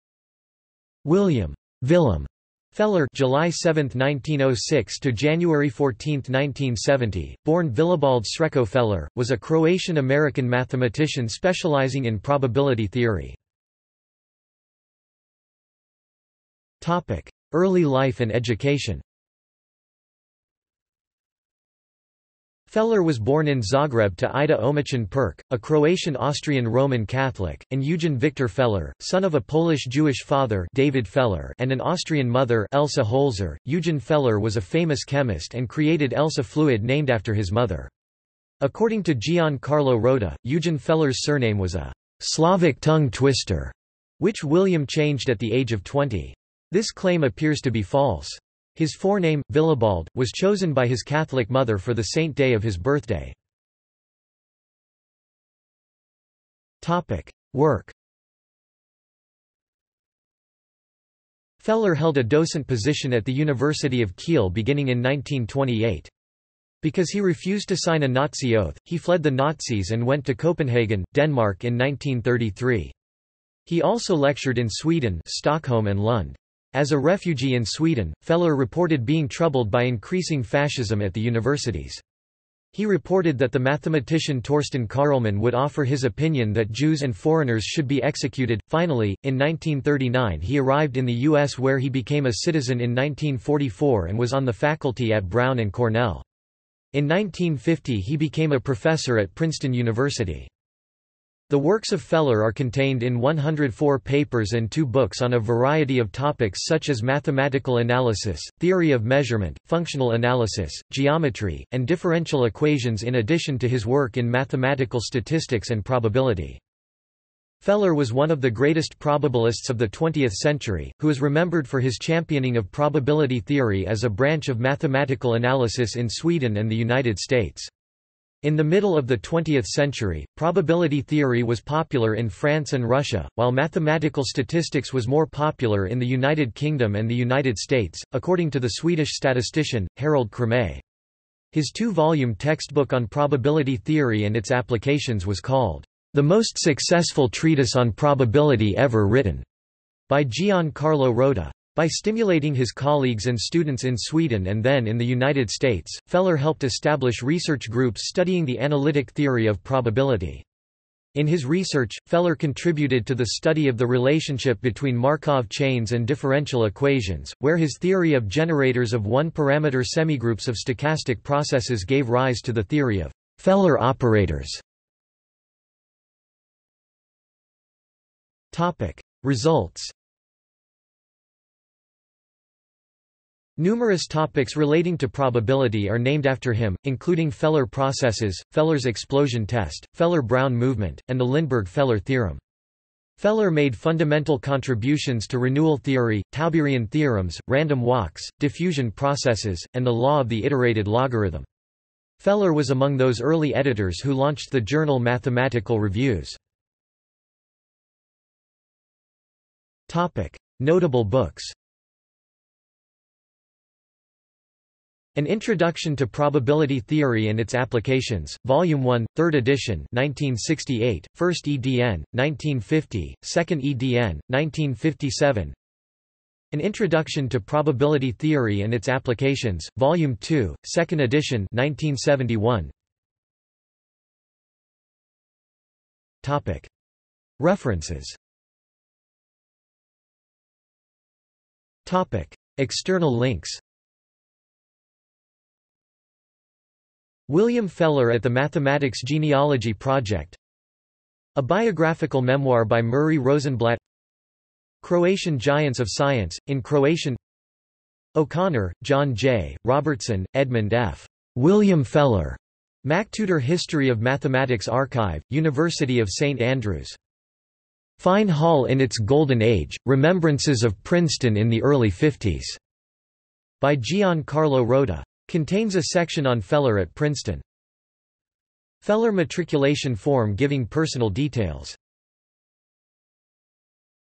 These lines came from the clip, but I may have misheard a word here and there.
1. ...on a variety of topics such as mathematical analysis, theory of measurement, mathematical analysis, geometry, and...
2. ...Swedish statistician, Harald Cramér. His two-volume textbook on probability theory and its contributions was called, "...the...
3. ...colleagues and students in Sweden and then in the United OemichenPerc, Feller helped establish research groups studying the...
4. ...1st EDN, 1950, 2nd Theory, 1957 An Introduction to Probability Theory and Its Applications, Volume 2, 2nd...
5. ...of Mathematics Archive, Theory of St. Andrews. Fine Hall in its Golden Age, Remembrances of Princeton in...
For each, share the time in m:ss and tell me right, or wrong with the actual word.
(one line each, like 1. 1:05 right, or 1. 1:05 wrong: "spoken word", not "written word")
1. 1:45 wrong: "functional", not "mathematical"
2. 2:18 wrong: "applications", not "contributions"
3. 2:32 wrong: "States", not "OemichenPerc"
4. 3:41 wrong: "EDN", not "Theory"
5. 4:23 wrong: "University", not "Theory".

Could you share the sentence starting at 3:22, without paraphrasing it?
Feller was among those early editors who launched the journal Mathematical Reviews.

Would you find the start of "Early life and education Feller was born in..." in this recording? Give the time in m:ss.
0:17.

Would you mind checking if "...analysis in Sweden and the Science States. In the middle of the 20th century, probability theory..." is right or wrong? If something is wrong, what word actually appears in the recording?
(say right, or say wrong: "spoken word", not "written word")
wrong: "United", not "Science".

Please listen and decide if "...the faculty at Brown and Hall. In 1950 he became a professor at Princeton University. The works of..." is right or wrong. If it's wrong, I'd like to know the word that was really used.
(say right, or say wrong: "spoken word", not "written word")
wrong: "Cornell", not "Hall".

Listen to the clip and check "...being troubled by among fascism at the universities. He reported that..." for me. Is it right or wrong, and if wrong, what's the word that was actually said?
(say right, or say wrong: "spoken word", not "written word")
wrong: "increasing", not "among".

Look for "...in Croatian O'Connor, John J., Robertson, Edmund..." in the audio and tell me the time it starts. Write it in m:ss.
4:16.